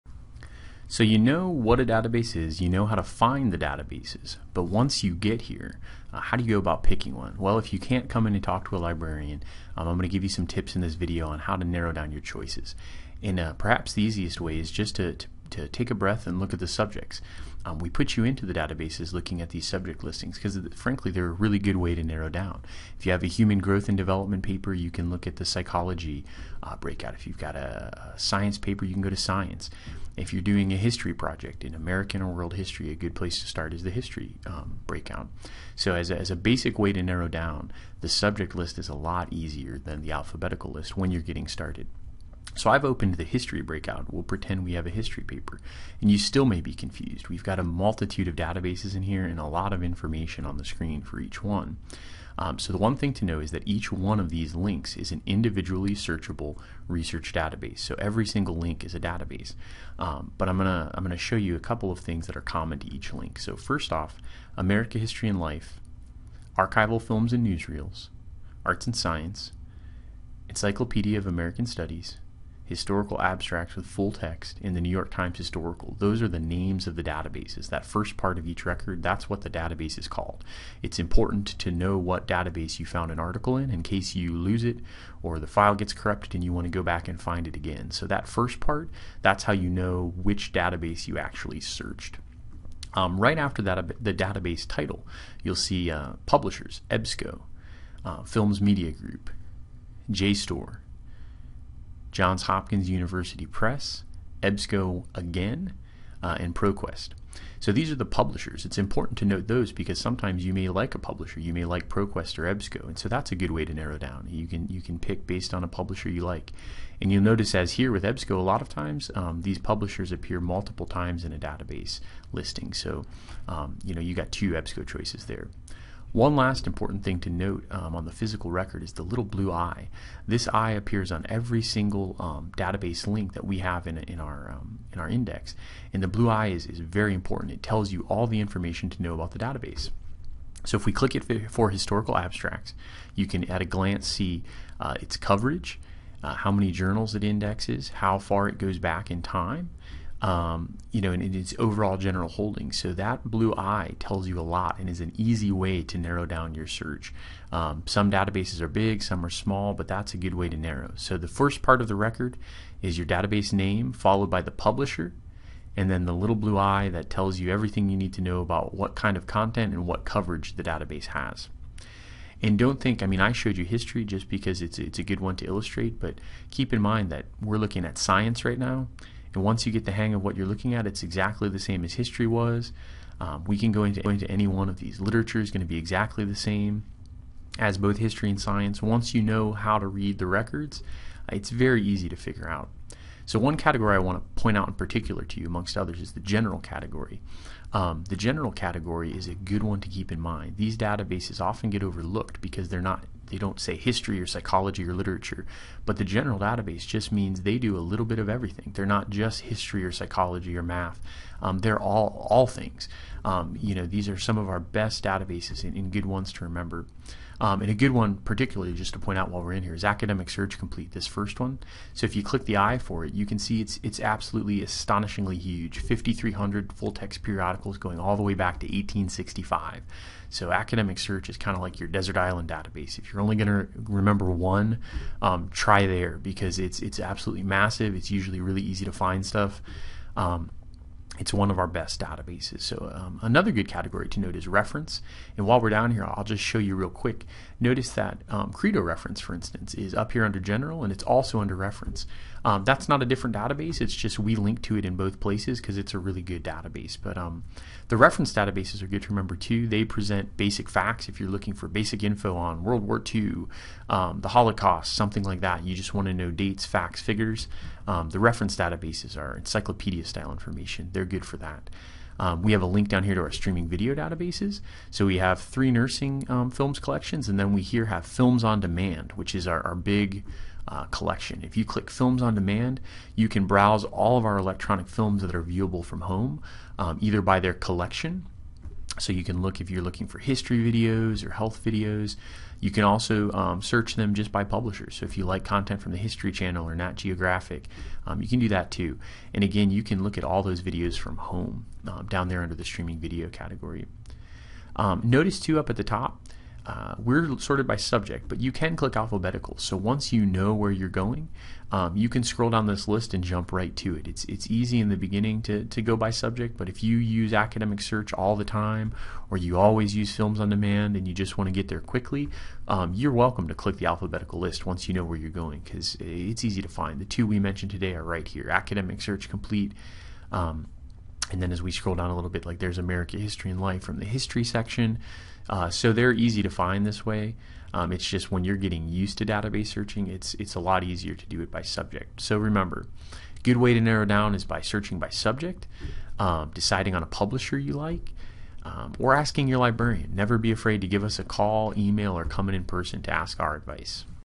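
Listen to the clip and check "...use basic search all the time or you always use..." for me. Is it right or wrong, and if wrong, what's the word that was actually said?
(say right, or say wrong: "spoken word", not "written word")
wrong: "academic", not "basic".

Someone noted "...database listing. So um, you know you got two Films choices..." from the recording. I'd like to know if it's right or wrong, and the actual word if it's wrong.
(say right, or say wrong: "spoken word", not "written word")
wrong: "EBSCO", not "Films".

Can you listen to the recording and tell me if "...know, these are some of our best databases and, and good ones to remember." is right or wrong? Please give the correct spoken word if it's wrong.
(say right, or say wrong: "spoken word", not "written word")
right.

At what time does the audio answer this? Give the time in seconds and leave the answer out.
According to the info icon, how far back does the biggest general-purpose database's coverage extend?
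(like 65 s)
228 s.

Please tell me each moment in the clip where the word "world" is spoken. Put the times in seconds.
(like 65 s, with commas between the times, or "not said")
32 s, 262 s.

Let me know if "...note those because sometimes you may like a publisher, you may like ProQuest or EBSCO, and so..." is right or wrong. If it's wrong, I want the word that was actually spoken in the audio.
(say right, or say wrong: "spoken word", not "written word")
right.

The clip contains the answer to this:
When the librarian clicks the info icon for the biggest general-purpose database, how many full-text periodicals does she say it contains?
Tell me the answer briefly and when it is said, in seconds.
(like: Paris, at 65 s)
5,300, at 225 s.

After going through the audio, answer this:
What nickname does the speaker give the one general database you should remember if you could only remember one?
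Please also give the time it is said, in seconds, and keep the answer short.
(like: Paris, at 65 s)
Desert Island database, at 231 s.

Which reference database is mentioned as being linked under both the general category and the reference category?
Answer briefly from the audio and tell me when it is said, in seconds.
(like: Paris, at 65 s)
Credo reference, at 248 s.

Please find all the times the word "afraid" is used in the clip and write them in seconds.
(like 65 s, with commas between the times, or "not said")
350 s.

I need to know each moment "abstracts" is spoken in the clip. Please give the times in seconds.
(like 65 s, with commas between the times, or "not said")
73 s, 142 s.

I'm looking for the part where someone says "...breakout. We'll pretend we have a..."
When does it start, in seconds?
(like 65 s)
43 s.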